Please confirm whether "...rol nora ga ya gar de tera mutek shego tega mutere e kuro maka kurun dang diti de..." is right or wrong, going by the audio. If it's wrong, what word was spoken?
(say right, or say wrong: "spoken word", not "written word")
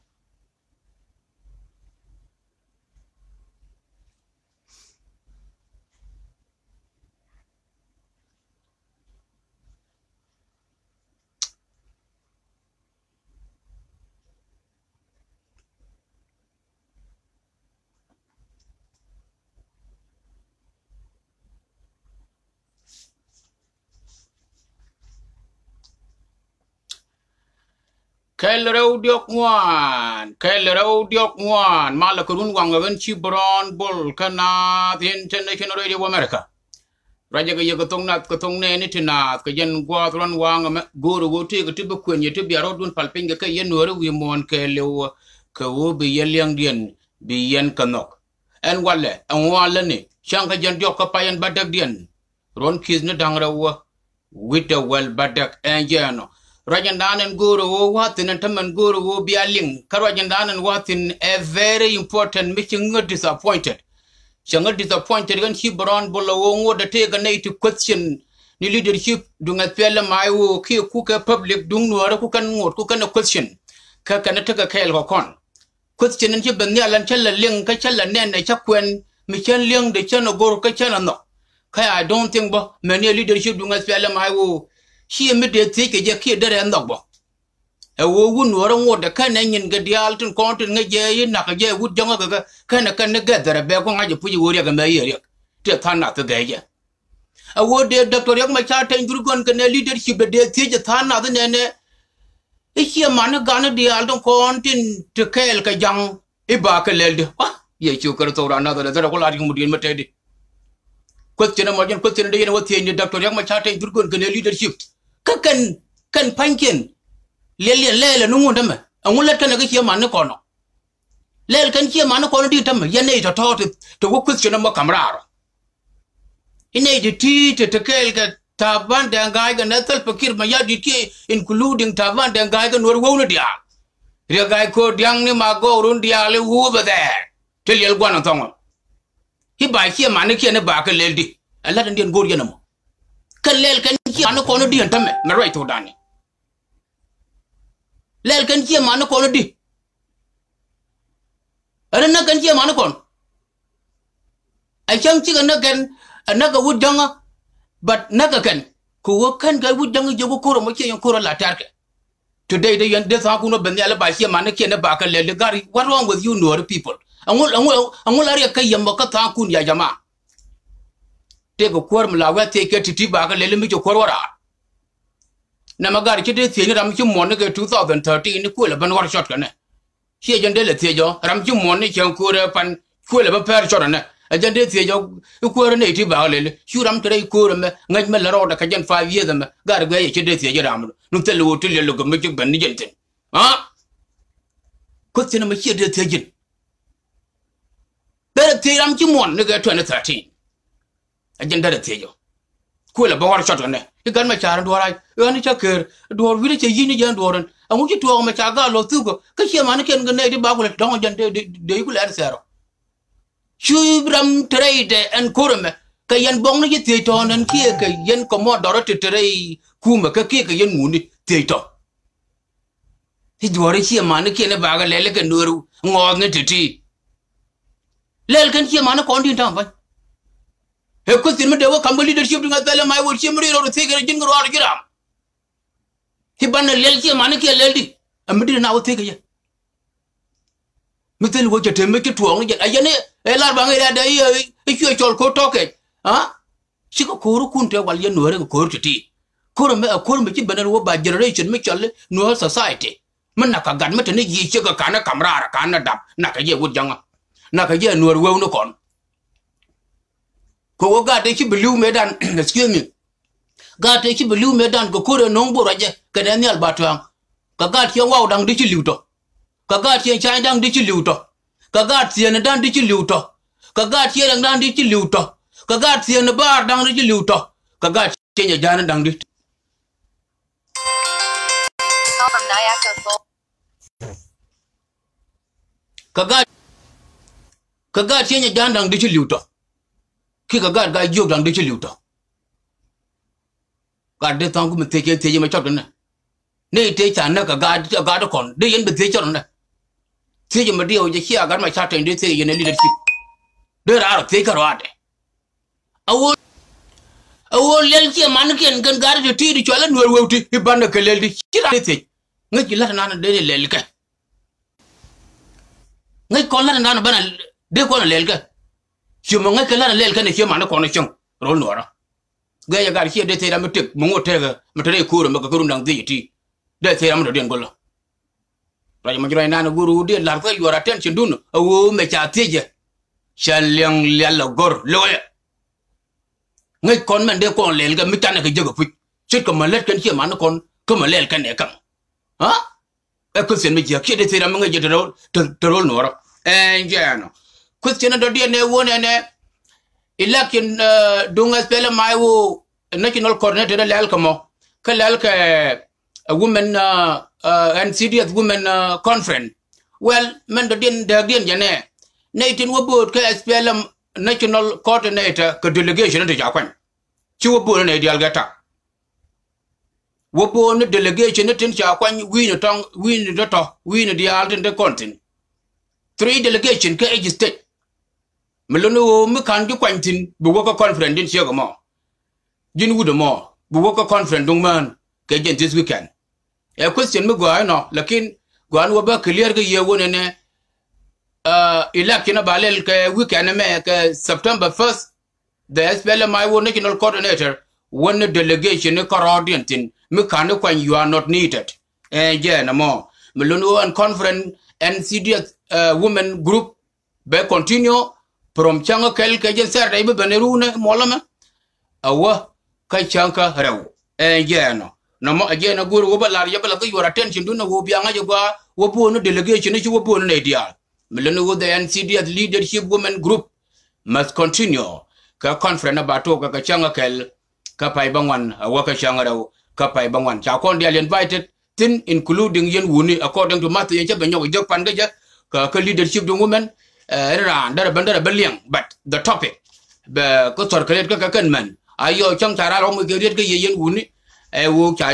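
wrong: "mungo", not "shego".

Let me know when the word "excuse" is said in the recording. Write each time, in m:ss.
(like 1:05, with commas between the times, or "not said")
4:22.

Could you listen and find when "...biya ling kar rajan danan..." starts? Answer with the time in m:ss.
0:59.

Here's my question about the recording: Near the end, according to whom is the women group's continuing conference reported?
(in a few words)
Matthew.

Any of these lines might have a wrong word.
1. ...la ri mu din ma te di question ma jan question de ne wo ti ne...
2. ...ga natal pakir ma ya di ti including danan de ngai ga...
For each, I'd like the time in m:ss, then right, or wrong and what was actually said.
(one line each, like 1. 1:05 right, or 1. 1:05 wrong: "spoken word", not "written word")
1. 1:49 right
2. 2:09 wrong: "taban", not "danan".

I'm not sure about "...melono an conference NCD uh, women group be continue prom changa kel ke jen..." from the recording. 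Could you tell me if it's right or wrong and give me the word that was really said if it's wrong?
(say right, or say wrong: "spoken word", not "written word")
right.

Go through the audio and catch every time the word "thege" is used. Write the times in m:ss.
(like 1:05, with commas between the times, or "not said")
3:53, 3:58.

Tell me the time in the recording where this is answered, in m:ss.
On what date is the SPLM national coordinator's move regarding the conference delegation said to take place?
6:34.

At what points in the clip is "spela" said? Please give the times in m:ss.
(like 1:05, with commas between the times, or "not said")
5:51, 6:03.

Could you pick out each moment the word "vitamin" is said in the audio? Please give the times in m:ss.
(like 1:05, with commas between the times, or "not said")
not said.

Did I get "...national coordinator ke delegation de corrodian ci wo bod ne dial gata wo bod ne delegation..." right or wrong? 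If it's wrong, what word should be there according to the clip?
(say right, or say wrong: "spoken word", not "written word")
wrong: "jakwan", not "corrodian".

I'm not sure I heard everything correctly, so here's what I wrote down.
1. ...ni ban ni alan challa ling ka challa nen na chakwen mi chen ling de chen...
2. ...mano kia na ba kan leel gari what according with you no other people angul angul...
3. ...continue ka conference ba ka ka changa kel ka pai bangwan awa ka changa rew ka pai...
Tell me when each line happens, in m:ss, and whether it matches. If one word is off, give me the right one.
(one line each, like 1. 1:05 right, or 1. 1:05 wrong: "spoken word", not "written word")
1. 1:16 right
2. 2:44 wrong: "wrong", not "according"
3. 7:04 right.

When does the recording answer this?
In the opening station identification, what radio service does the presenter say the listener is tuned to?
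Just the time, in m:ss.
0:35.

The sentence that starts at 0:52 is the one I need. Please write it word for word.
Ron kizne ni dangra wa, wita wel badak en jeno.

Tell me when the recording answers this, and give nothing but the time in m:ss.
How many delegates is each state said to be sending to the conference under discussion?
6:16.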